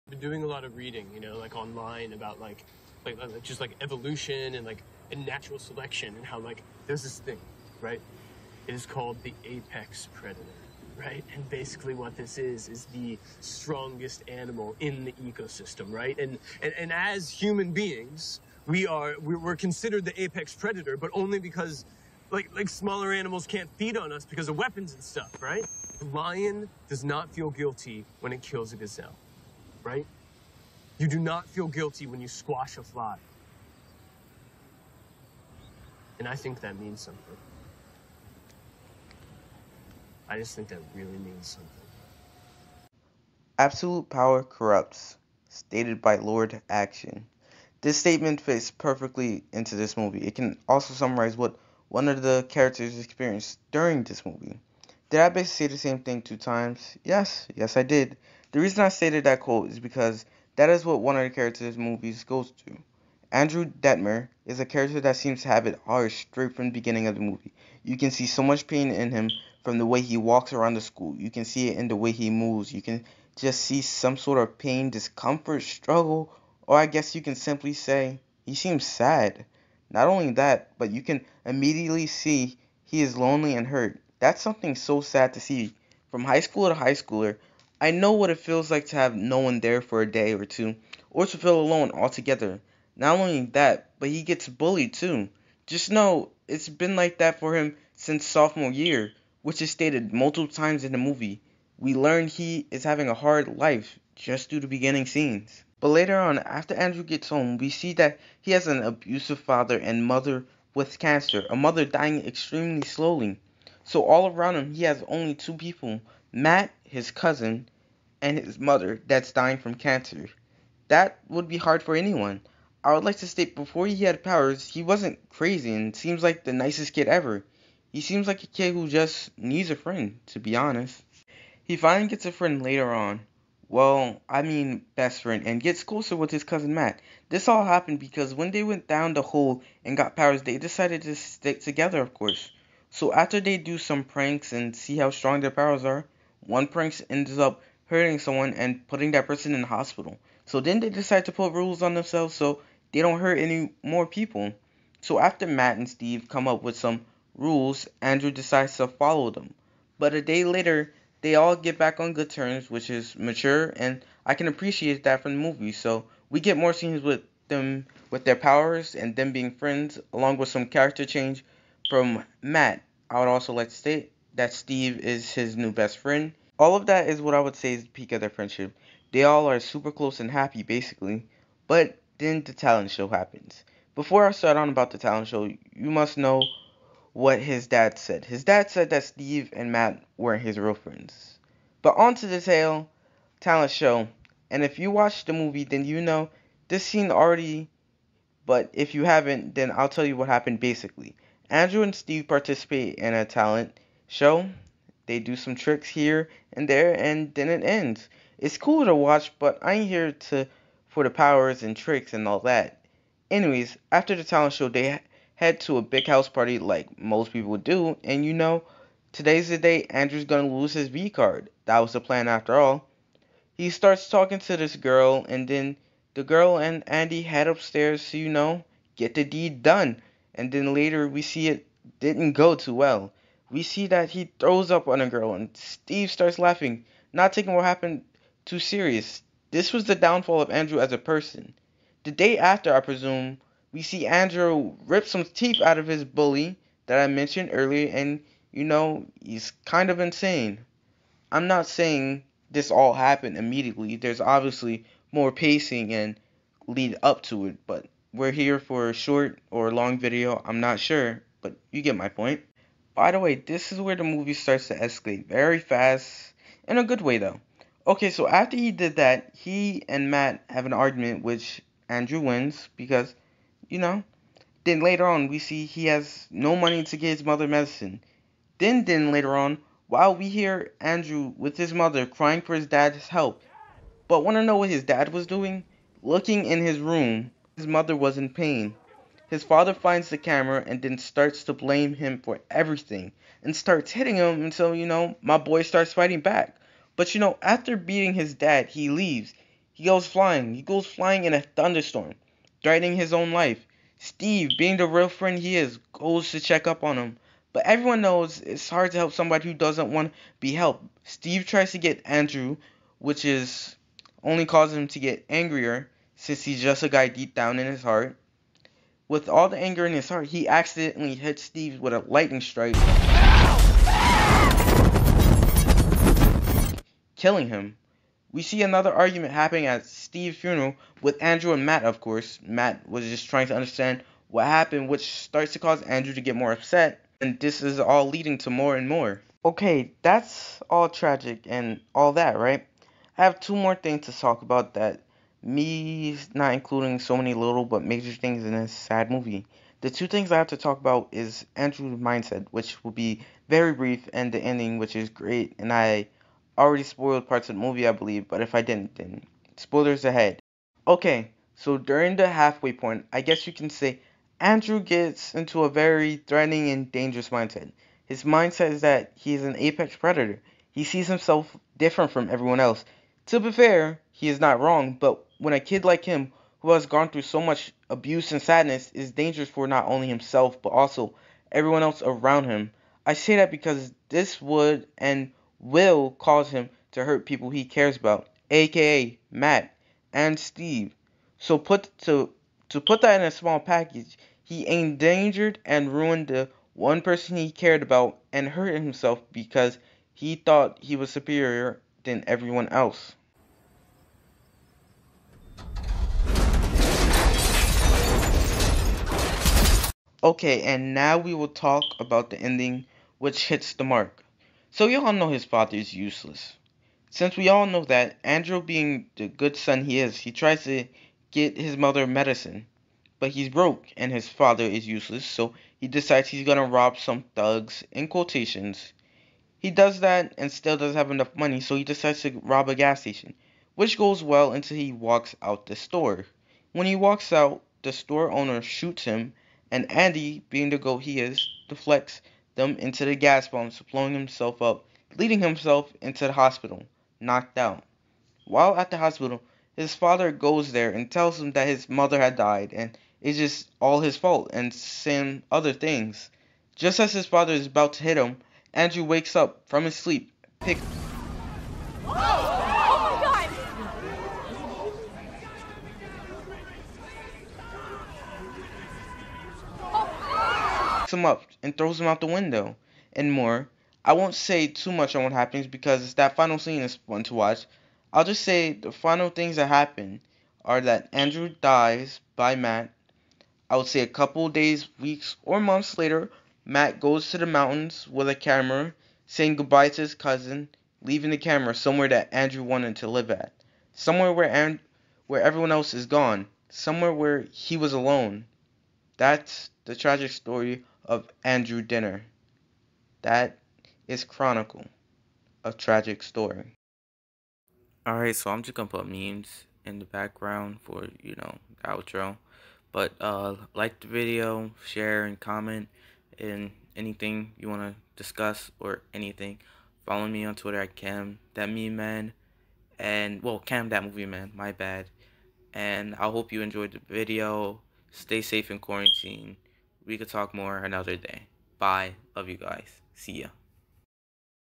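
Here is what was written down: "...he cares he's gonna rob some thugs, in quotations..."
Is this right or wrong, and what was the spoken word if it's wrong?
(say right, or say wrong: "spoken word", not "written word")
wrong: "decides", not "cares".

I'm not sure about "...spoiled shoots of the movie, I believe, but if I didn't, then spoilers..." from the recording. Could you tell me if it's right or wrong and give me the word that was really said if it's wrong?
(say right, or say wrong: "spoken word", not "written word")
wrong: "parts", not "shoots".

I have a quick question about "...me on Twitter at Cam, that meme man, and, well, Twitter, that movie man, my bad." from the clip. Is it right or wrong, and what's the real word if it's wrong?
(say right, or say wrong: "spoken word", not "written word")
wrong: "Cam", not "Twitter".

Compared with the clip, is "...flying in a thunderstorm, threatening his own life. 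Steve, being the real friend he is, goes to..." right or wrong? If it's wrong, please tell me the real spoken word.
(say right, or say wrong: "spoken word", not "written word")
right.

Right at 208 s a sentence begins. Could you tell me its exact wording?
It's cool to watch, but I ain't here to for the powers and tricks and all that.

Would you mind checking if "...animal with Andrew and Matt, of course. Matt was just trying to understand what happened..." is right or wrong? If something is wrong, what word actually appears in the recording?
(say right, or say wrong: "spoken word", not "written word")
wrong: "funeral", not "animal".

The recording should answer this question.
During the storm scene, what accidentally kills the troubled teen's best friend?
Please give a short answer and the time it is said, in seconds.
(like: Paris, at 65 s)
lightning strike, at 322 s.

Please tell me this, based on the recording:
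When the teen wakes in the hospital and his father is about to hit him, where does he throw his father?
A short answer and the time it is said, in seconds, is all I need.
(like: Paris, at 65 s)
out the window, at 472 s.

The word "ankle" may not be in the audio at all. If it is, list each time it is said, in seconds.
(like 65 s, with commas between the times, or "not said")
not said.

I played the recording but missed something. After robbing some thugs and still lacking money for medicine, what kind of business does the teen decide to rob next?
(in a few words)
gas station.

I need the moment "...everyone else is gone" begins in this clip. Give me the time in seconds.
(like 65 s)
495 s.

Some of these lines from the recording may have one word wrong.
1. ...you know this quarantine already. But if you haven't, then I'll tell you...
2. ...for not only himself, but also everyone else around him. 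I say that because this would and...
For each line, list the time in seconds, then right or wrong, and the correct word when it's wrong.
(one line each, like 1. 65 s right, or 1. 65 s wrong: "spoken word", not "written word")
1. 195 s wrong: "scene", not "quarantine"
2. 379 s right.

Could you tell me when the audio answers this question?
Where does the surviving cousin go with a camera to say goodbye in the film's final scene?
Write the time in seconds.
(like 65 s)
487 s.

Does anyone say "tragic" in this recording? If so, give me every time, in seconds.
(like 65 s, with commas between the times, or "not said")
340 s, 499 s, 505 s.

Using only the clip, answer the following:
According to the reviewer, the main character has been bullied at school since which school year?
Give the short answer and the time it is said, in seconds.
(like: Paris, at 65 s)
sophomore year, at 98 s.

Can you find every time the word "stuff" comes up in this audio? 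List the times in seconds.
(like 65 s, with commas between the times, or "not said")
25 s.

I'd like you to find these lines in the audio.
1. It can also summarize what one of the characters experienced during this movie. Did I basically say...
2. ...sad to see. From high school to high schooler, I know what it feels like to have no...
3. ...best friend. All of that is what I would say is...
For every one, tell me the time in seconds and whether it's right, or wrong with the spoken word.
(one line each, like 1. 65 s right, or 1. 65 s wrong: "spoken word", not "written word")
1. 50 s right
2. 84 s right
3. 175 s right.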